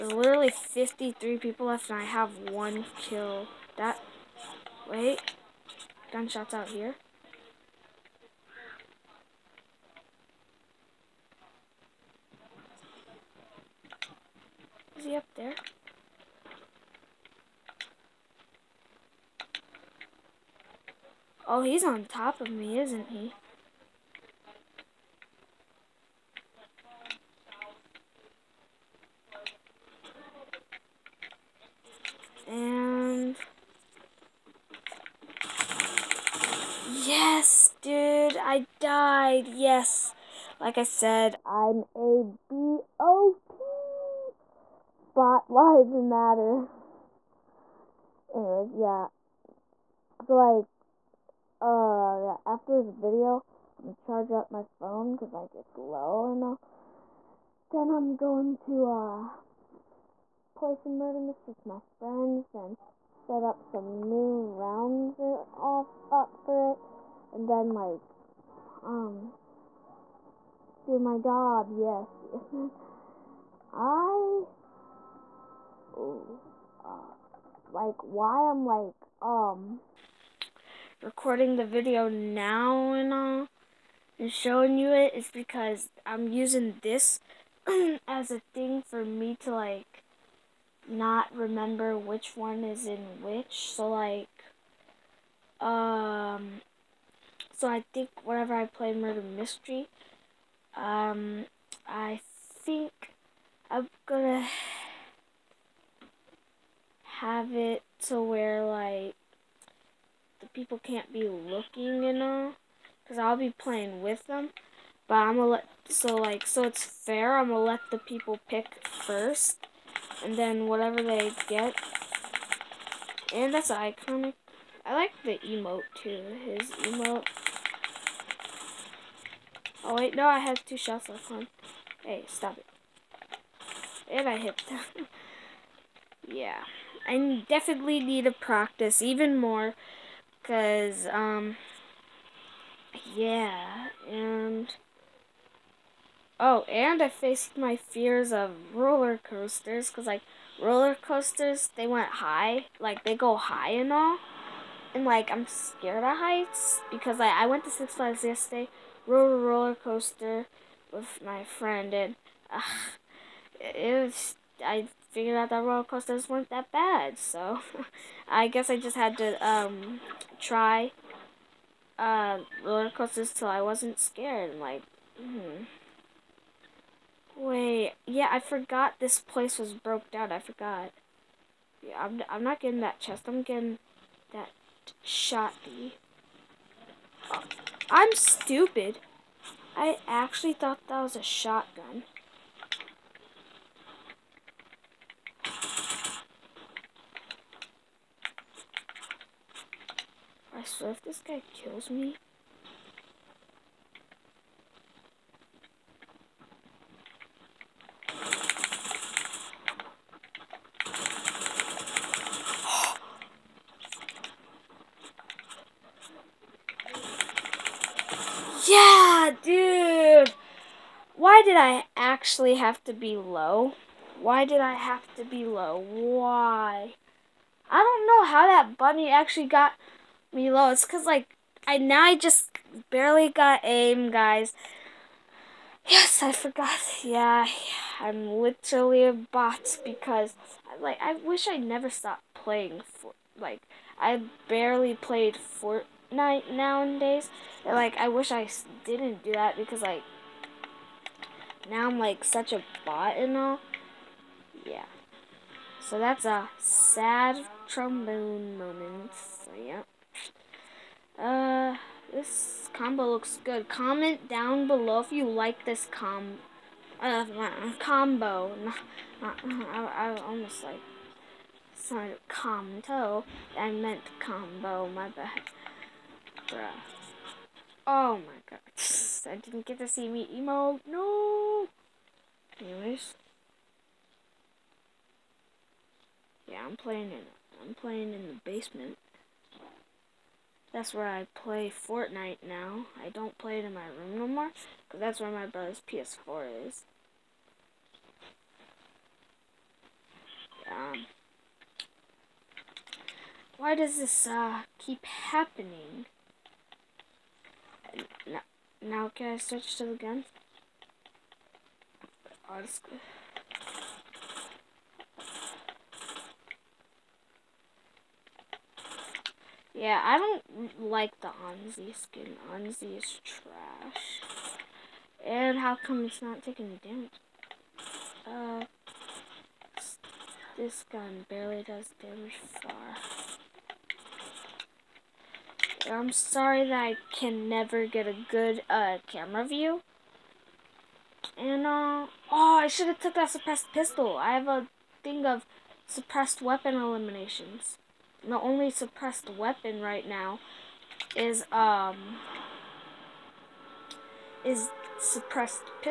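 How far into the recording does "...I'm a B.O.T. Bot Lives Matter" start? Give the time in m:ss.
0:41.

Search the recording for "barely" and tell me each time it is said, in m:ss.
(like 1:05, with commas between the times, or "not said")
3:52, 4:04, 5:31.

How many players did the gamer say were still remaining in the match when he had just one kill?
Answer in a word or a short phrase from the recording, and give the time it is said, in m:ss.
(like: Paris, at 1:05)
53, at 0:00.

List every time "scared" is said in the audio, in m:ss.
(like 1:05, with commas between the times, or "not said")
2:35, 2:53.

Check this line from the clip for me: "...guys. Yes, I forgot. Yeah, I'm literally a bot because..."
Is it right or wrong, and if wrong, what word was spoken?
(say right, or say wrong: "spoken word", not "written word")
right.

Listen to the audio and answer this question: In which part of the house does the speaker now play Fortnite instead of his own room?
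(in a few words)
the basement.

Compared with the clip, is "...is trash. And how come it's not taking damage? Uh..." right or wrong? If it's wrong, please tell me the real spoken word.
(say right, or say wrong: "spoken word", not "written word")
right.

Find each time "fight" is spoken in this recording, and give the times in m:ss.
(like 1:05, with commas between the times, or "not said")
not said.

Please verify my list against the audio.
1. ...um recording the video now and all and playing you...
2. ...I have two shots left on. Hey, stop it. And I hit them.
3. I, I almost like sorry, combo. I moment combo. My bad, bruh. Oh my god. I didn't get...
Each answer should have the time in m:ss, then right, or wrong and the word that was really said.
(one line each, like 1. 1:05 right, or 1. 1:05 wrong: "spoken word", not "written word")
1. 1:19 wrong: "showing", not "playing"
2. 2:10 right
3. 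4:29 wrong: "meant", not "moment".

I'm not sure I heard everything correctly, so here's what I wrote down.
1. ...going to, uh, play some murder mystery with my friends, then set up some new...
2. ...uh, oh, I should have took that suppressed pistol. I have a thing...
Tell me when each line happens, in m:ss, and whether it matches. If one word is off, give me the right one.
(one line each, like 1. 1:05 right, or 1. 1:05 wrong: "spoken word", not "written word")
1. 0:58 right
2. 5:41 right.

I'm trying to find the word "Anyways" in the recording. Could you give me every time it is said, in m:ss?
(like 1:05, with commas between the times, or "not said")
0:48, 4:42.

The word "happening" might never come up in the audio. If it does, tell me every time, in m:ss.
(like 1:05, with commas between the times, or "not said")
5:05.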